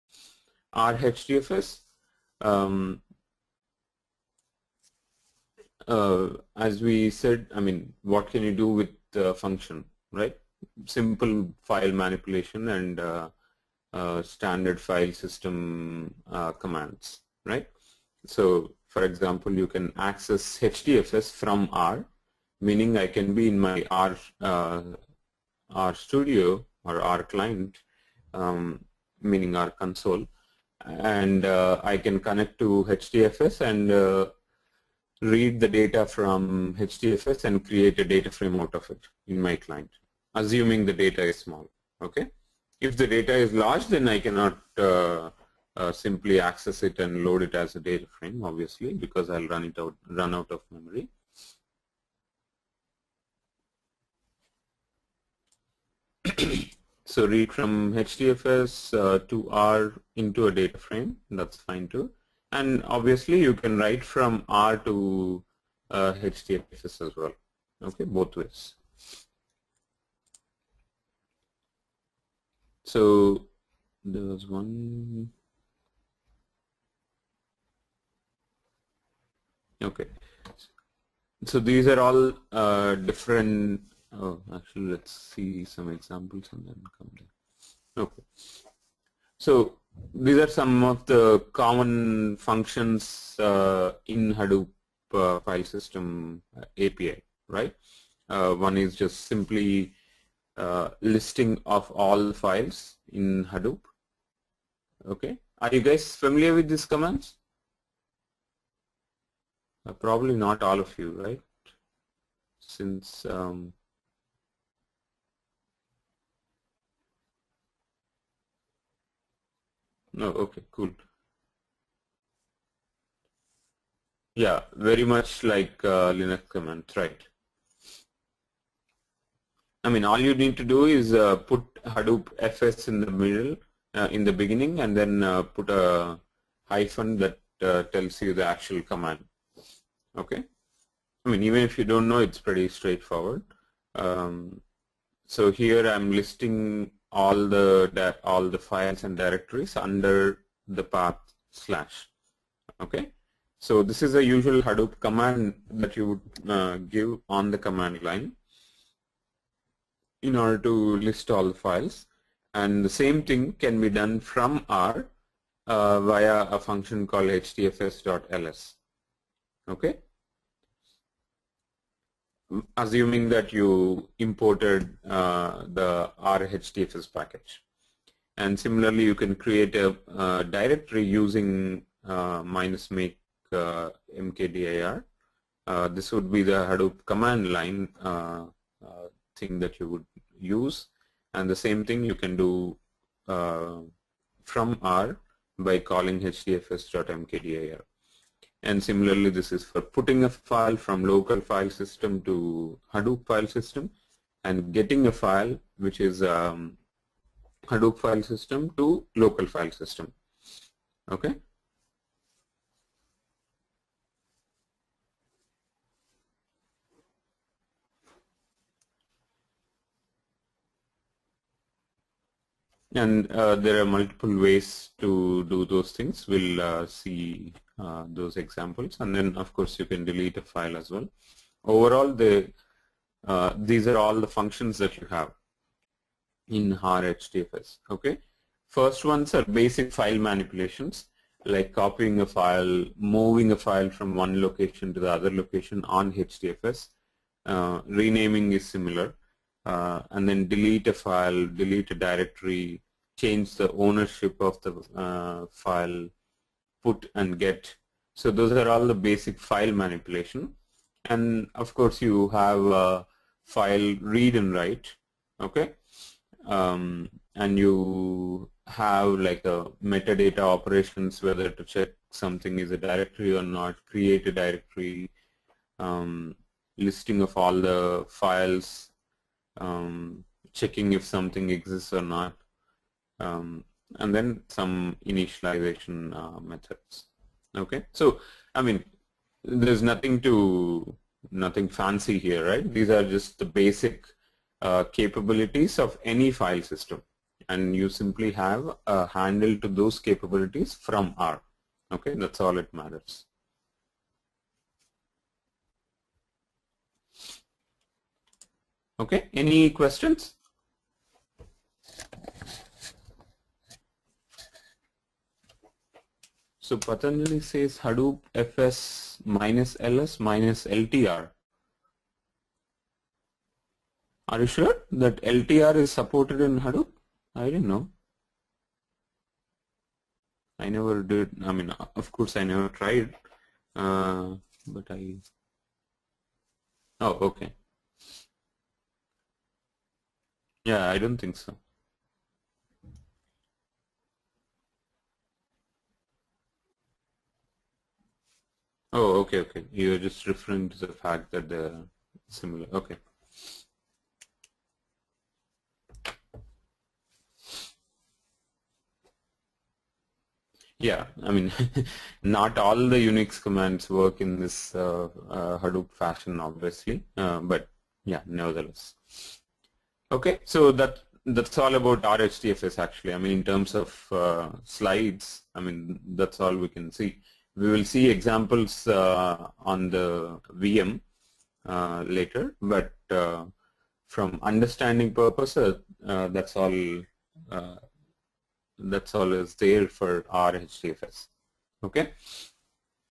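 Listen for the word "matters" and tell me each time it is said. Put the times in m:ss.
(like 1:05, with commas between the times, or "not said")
5:02.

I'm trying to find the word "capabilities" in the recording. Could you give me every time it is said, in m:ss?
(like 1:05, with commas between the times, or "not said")
4:54, 4:59.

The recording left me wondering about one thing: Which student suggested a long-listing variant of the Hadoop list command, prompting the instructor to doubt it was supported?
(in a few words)
Patanjali.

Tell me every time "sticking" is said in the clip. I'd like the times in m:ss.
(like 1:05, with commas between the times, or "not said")
not said.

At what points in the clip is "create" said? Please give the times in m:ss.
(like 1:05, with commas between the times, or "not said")
0:37, 2:59, 4:33.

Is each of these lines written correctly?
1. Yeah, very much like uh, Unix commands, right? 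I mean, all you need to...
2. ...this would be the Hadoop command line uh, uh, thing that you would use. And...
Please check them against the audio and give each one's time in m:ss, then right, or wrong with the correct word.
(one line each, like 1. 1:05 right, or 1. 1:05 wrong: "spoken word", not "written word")
1. 2:04 wrong: "Linux", not "Unix"
2. 3:05 right.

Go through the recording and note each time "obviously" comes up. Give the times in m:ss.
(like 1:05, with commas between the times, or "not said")
0:48, 1:02, 6:06.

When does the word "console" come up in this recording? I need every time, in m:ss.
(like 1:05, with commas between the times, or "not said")
0:29.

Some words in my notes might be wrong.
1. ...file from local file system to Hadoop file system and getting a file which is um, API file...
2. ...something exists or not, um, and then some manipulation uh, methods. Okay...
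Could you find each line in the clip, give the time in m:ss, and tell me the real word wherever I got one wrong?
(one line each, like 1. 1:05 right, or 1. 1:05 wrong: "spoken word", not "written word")
1. 3:20 wrong: "Hadoop", not "API"
2. 4:41 wrong: "initialization", not "manipulation".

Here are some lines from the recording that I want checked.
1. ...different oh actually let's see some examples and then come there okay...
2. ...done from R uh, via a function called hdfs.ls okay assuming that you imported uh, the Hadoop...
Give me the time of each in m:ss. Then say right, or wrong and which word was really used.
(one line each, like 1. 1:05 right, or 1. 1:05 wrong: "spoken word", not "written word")
1. 1:22 right
2. 2:43 wrong: "RHDFS", not "Hadoop".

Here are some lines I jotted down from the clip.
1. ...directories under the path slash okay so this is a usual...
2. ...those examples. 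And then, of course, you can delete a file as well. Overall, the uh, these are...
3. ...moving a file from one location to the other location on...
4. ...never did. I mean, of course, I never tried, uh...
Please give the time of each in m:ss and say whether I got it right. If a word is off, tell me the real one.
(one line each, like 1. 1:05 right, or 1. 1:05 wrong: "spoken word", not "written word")
1. 2:29 right
2. 3:48 right
3. 4:02 right
4. 5:30 right.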